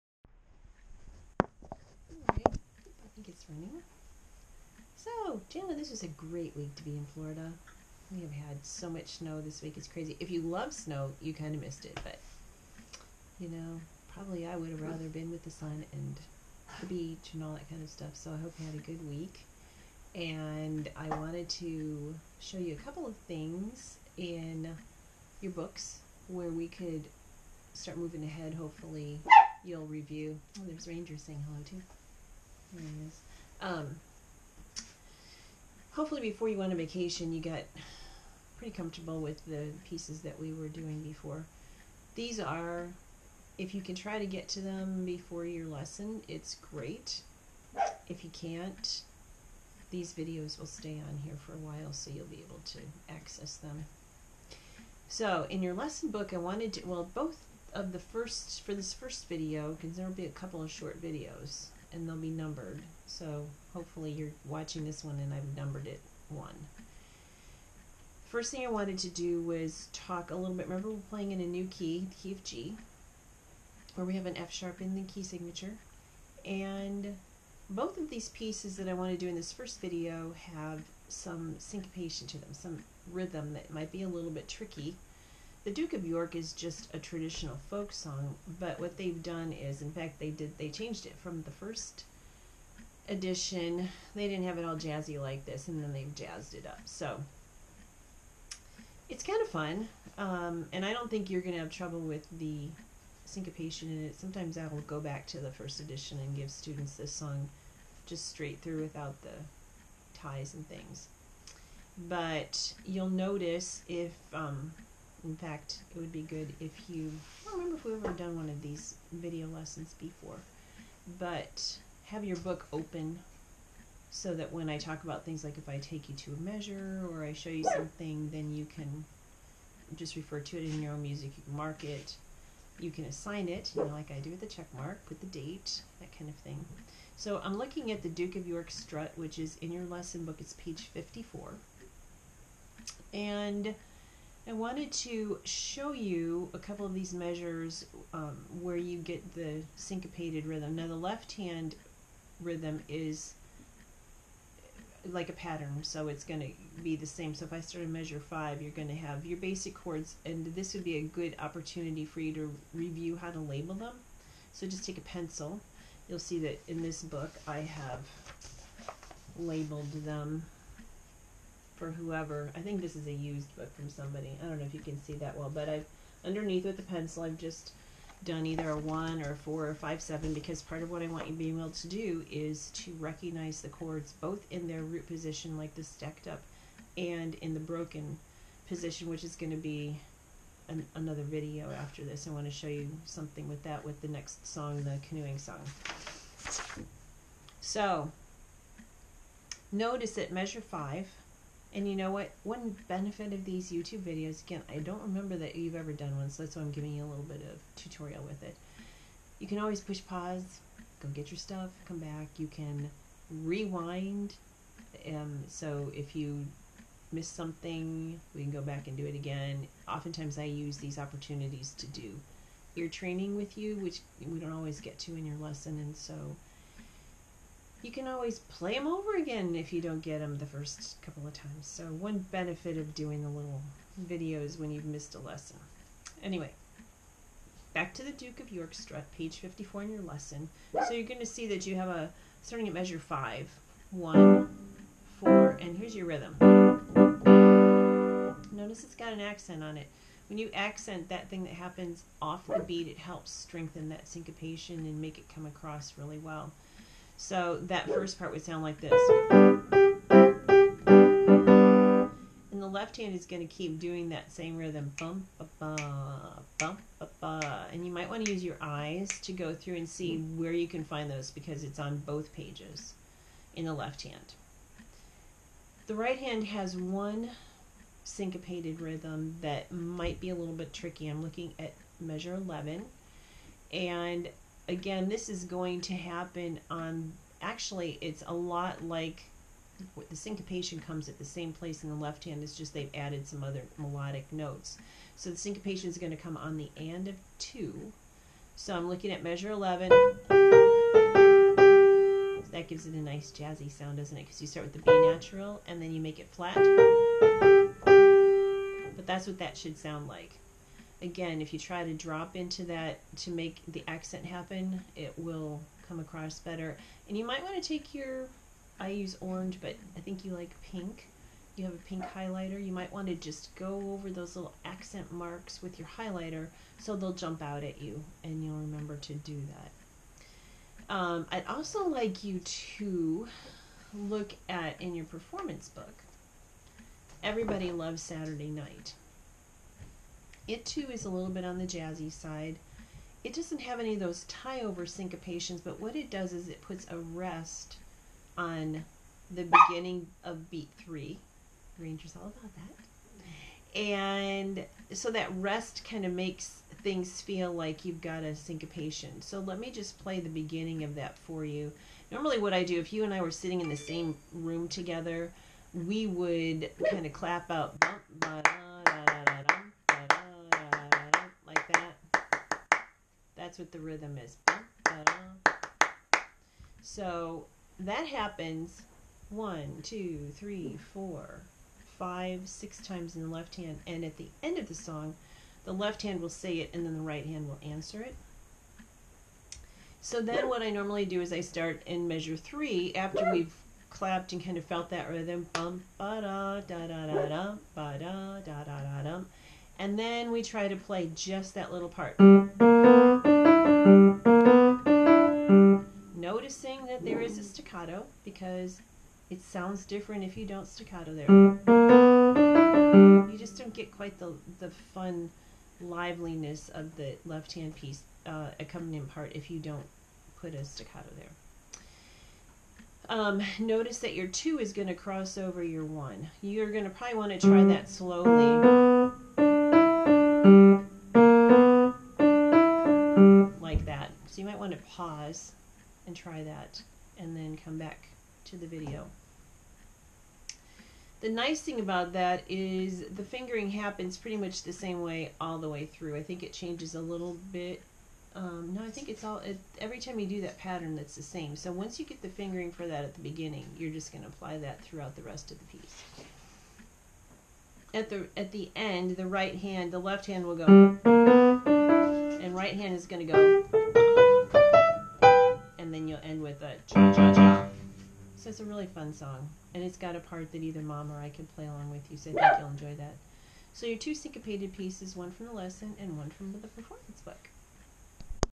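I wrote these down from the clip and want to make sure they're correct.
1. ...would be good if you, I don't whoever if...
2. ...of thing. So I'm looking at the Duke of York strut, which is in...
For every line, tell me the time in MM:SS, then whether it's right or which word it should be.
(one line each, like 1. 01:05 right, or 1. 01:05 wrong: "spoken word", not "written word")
1. 01:55 wrong: "remember", not "whoever"
2. 02:16 right.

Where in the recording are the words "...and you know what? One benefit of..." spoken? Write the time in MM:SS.
03:21.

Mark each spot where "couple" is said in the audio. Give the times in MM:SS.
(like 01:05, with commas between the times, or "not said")
00:22, 01:00, 02:26, 03:51.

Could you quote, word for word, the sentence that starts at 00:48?
If you can't, these videos will stay on here for a while so you'll be able to access them.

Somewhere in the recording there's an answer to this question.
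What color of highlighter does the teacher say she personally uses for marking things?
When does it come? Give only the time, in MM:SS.
05:19.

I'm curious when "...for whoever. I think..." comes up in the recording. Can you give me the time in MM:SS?
02:51.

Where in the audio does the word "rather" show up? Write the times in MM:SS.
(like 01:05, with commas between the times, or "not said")
00:14.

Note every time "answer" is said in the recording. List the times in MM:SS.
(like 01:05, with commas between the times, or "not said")
06:27.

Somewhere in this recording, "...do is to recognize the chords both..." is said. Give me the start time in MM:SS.
03:01.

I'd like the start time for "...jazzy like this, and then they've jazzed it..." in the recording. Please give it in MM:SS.
01:34.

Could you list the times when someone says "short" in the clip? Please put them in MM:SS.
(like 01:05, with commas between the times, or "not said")
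01:00.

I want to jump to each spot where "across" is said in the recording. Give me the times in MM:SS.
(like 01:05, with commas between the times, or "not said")
04:15, 05:15.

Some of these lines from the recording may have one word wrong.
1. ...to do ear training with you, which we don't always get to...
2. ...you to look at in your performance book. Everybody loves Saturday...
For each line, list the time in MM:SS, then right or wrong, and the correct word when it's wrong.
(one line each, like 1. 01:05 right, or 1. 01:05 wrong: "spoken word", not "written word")
1. 03:41 right
2. 05:32 right.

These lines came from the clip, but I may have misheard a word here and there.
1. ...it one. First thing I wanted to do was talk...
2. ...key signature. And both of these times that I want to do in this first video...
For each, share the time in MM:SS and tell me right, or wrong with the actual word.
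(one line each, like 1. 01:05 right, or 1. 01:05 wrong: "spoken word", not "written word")
1. 01:05 right
2. 01:15 wrong: "pieces", not "times".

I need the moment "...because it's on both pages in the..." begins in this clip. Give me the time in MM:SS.
04:31.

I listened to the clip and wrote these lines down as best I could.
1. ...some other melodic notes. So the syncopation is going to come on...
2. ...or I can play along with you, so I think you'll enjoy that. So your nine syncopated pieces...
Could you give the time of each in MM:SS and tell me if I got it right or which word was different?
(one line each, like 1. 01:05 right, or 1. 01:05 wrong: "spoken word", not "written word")
1. 04:53 right
2. 07:51 wrong: "two", not "nine".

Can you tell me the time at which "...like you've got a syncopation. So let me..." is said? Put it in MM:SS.
05:57.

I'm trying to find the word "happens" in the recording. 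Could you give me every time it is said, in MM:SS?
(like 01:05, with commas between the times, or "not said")
04:11, 04:45, 05:14, 06:18, 07:23.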